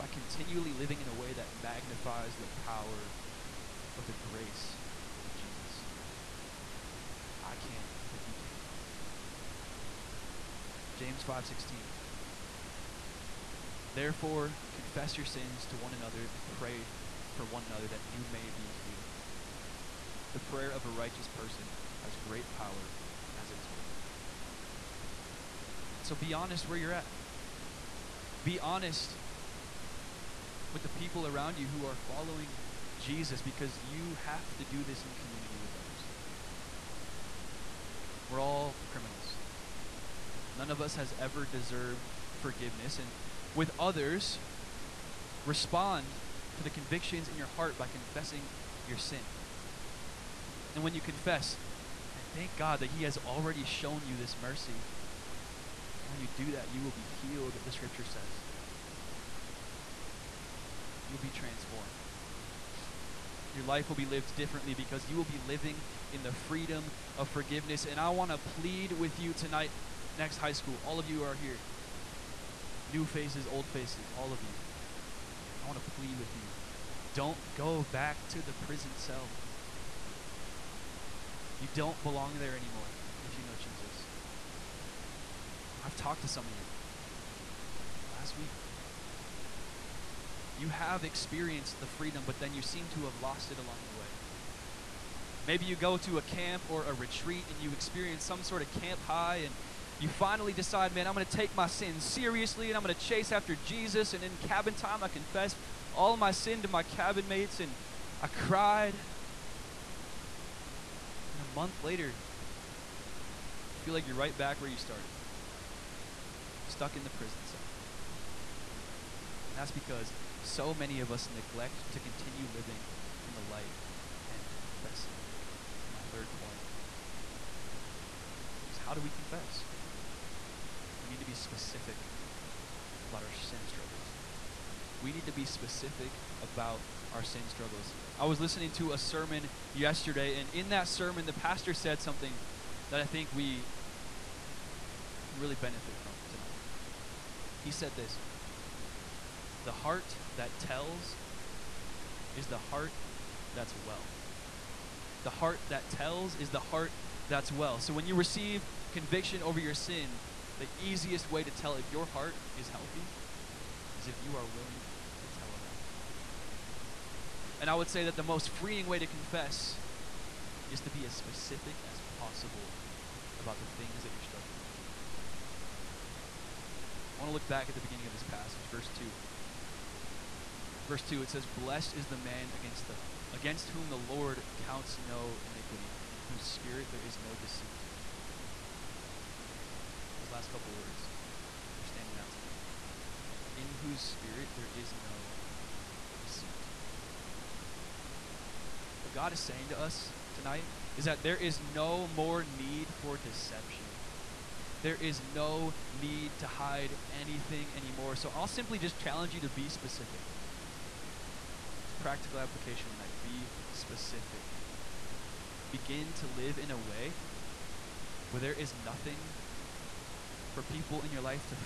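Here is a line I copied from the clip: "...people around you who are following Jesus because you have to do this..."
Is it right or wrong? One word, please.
right.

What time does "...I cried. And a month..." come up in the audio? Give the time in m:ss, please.
1:48.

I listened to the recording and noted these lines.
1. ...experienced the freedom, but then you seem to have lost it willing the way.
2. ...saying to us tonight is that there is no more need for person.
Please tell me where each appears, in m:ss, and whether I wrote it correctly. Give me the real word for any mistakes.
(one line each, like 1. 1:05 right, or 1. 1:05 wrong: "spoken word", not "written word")
1. 1:31 wrong: "along", not "willing"
2. 3:19 wrong: "deception", not "person".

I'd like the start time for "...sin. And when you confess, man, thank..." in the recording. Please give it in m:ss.
0:48.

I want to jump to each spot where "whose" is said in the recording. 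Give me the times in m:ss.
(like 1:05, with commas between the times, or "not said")
3:06, 3:13.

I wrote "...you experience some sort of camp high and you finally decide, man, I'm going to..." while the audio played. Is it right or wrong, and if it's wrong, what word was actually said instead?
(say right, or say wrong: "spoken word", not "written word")
right.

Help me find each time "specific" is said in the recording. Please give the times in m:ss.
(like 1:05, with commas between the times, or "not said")
2:11, 2:15, 2:51, 3:29, 3:33.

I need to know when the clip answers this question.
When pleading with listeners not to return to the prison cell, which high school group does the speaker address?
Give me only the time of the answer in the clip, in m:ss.
1:10.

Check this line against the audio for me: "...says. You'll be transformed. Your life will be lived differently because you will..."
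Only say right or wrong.
right.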